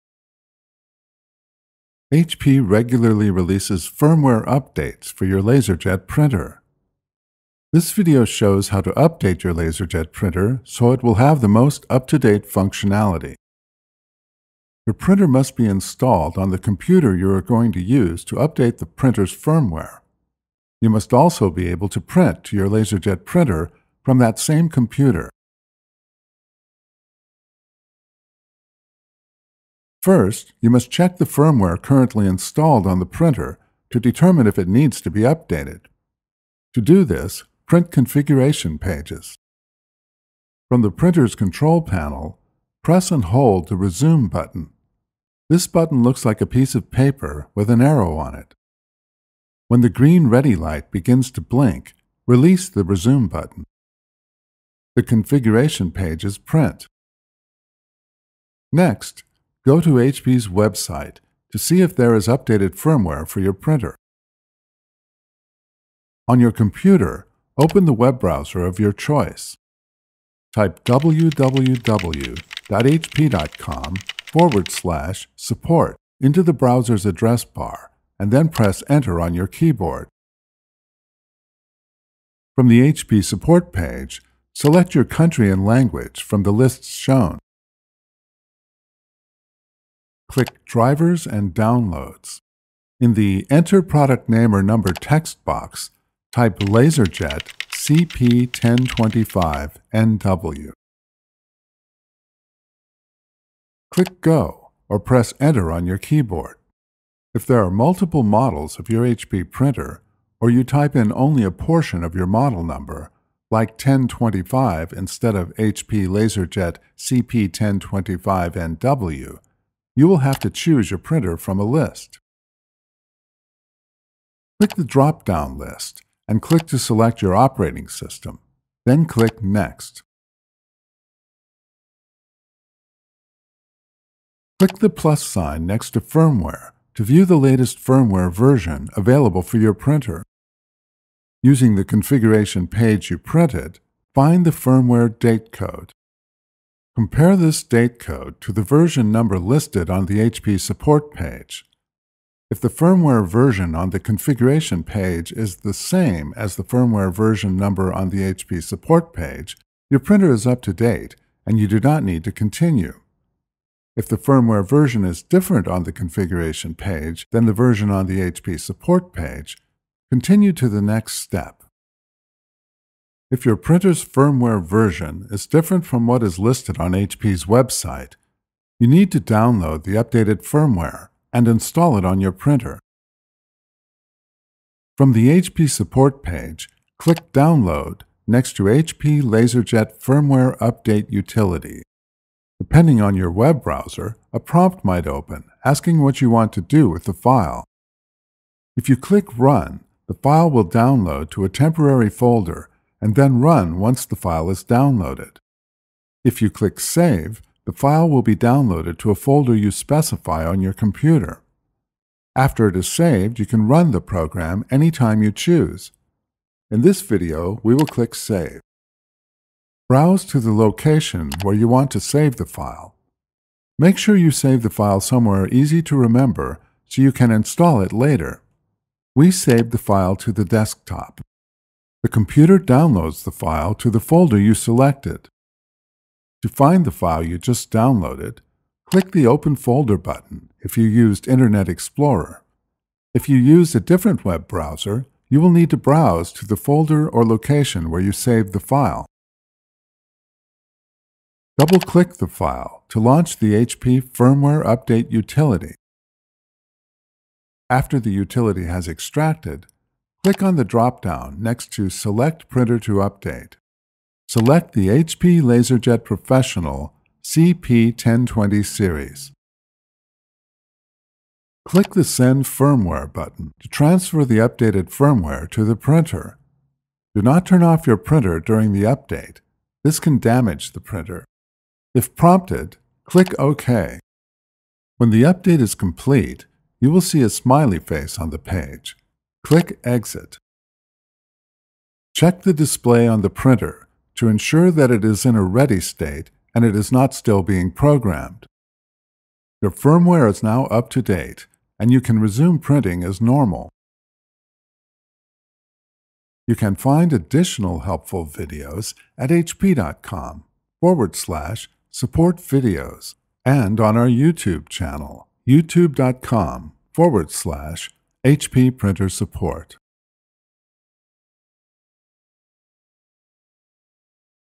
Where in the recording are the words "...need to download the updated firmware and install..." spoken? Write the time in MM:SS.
02:58.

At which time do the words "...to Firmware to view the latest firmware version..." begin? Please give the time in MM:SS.
02:15.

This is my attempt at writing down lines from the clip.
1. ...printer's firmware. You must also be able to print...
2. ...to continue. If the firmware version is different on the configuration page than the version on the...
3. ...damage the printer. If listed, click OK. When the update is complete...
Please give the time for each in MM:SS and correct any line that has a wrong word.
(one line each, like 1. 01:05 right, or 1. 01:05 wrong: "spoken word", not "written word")
1. 00:18 right
2. 02:42 right
3. 04:40 wrong: "prompted", not "listed".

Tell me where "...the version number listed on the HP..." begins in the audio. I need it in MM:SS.
02:28.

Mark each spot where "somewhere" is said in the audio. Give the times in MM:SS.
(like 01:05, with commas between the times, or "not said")
03:45.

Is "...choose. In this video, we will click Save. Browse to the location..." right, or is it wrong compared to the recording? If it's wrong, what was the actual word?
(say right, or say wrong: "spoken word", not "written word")
right.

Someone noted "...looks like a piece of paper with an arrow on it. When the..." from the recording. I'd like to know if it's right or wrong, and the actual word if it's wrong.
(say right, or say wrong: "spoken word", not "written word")
right.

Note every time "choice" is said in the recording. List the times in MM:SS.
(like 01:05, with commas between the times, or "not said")
01:08.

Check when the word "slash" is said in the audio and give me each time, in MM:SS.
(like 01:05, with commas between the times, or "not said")
01:14, 05:11, 05:17.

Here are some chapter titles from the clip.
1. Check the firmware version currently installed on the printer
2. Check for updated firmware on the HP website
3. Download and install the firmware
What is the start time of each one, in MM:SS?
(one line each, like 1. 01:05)
1. 00:29
2. 00:58
3. 02:52.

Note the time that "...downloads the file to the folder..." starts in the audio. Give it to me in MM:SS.
03:52.